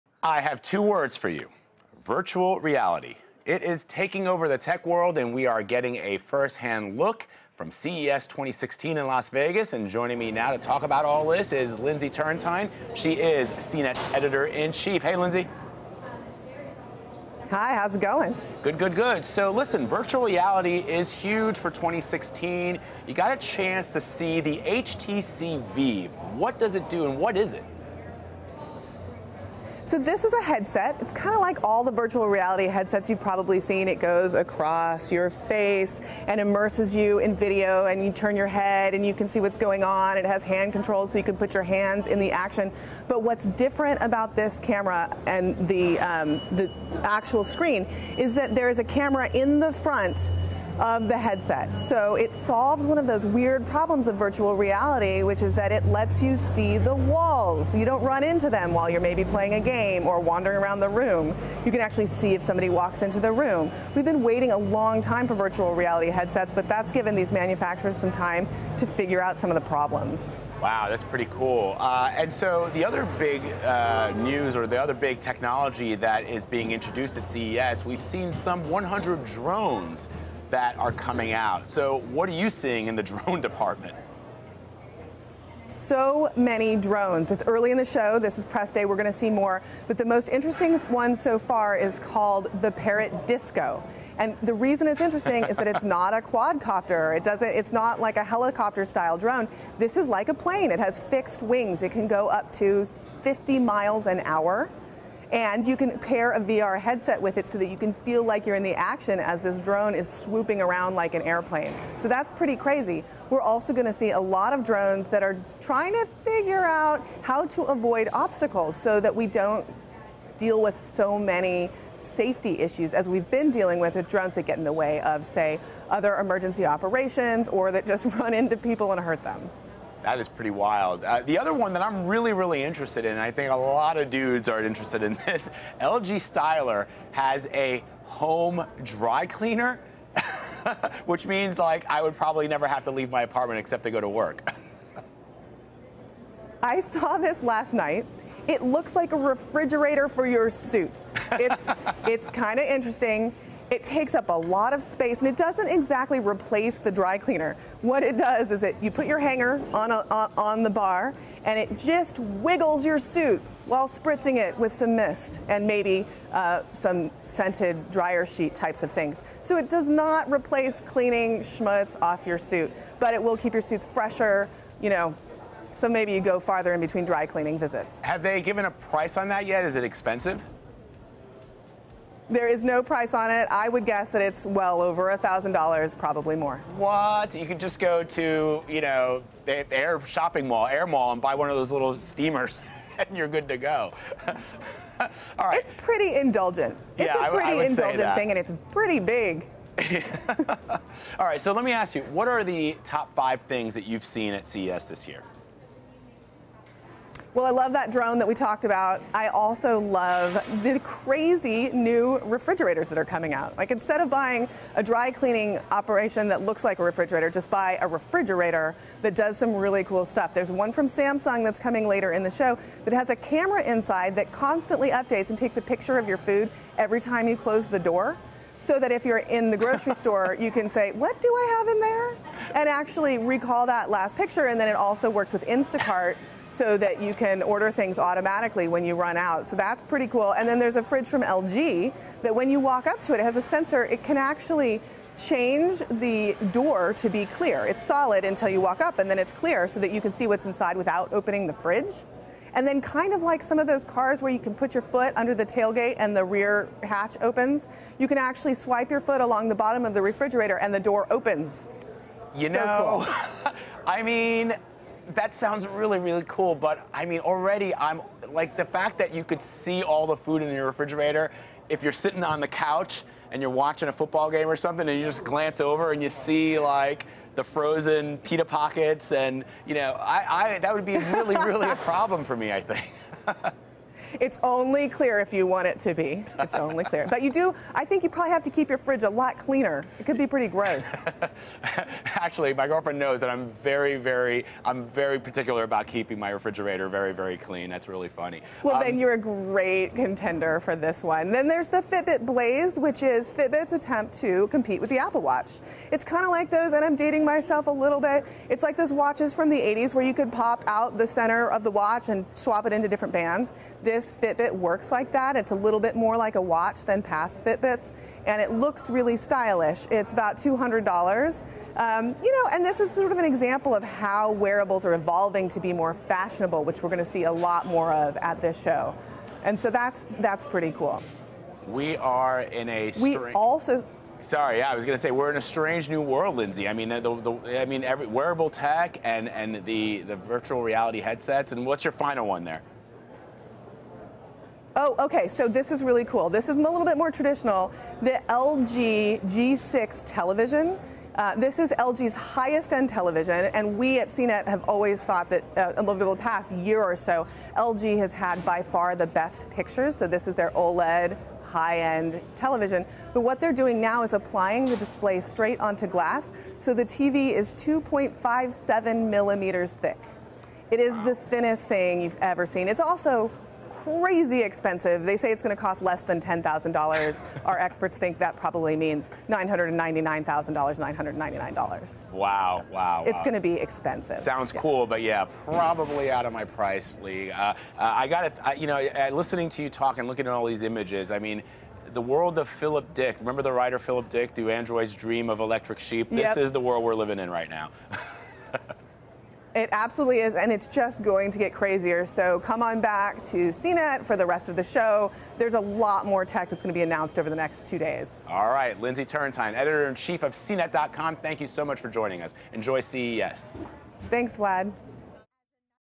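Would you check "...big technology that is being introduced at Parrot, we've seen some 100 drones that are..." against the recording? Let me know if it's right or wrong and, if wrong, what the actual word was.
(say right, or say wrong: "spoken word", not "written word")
wrong: "CES", not "Parrot".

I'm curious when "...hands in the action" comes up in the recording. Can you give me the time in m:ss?
0:41.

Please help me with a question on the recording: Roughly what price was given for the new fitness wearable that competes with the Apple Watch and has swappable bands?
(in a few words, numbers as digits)
$200.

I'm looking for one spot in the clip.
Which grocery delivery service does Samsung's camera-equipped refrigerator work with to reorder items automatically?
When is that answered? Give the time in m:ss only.
3:55.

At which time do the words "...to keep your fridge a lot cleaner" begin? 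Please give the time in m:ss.
4:48.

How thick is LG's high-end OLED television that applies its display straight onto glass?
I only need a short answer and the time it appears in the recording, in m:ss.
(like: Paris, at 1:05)
2.57 millimeters, at 6:07.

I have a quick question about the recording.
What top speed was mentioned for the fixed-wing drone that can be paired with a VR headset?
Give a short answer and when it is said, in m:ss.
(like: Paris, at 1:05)
50 miles an hour, at 1:42.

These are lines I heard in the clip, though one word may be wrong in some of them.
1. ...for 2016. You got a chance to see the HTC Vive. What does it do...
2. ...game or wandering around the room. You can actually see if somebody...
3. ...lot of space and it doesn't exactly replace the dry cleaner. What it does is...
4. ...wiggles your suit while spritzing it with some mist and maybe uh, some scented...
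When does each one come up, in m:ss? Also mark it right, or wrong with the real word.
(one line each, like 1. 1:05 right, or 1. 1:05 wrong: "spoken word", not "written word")
1. 0:21 right
2. 0:59 right
3. 2:34 right
4. 2:42 right.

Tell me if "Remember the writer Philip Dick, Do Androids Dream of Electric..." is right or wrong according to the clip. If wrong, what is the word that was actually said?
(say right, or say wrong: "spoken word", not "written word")
right.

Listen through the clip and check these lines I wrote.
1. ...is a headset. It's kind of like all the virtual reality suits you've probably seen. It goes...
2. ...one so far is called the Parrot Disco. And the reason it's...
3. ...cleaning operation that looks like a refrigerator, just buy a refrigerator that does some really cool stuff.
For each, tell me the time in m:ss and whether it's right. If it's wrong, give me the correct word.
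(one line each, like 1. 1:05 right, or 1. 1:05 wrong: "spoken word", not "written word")
1. 0:30 wrong: "headsets", not "suits"
2. 1:30 right
3. 3:35 right.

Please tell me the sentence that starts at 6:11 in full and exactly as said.
the thinnest thing you've ever seen.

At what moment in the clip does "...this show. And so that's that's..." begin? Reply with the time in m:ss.
5:28.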